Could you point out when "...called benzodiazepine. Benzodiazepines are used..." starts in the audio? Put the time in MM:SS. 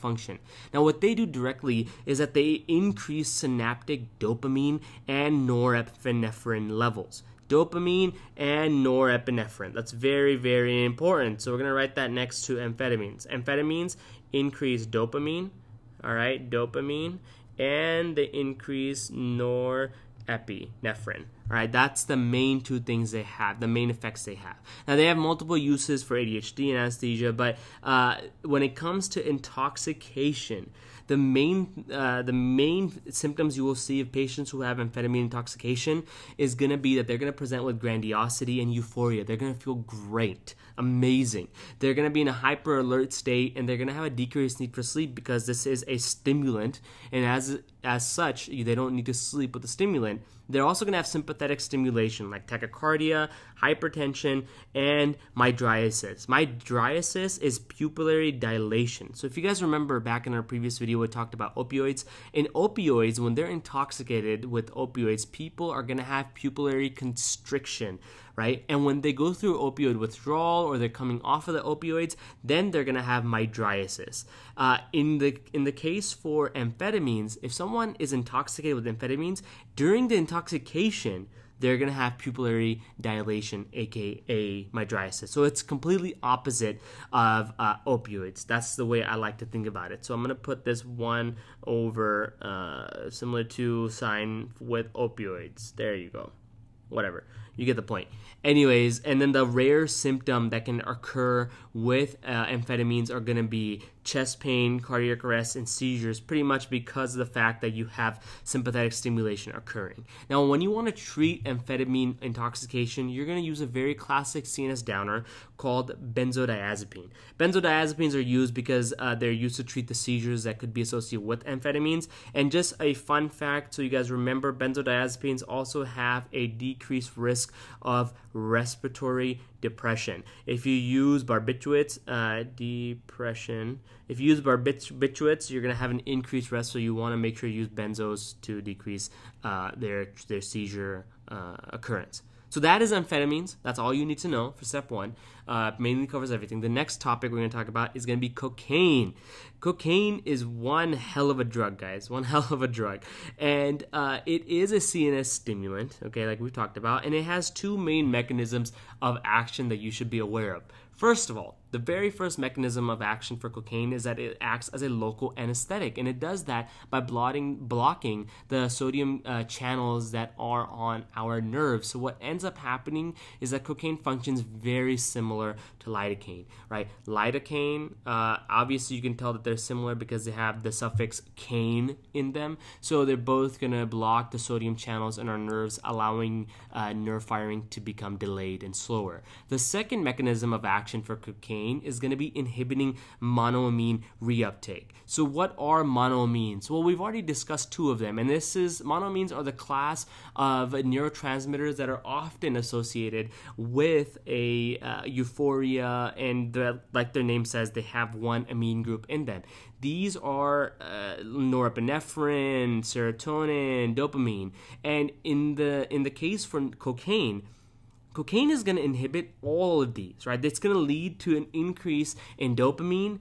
01:55.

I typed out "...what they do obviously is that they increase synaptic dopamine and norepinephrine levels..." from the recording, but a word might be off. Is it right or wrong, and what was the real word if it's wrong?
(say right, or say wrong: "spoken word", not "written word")
wrong: "directly", not "obviously".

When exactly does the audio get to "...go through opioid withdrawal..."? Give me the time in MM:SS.
01:09.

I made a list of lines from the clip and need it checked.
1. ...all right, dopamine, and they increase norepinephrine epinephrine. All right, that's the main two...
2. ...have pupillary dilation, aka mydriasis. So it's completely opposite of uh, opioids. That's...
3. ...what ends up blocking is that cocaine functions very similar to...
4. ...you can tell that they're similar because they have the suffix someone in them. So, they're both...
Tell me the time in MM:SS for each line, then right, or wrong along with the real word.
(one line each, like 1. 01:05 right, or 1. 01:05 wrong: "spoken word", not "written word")
1. 00:16 right
2. 01:21 right
3. 02:51 wrong: "happening", not "blocking"
4. 02:58 wrong: "caine", not "someone".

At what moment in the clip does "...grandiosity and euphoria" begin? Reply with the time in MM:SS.
00:37.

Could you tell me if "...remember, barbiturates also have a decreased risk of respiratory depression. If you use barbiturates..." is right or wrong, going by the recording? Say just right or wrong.
wrong.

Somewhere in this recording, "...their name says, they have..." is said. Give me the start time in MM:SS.
03:27.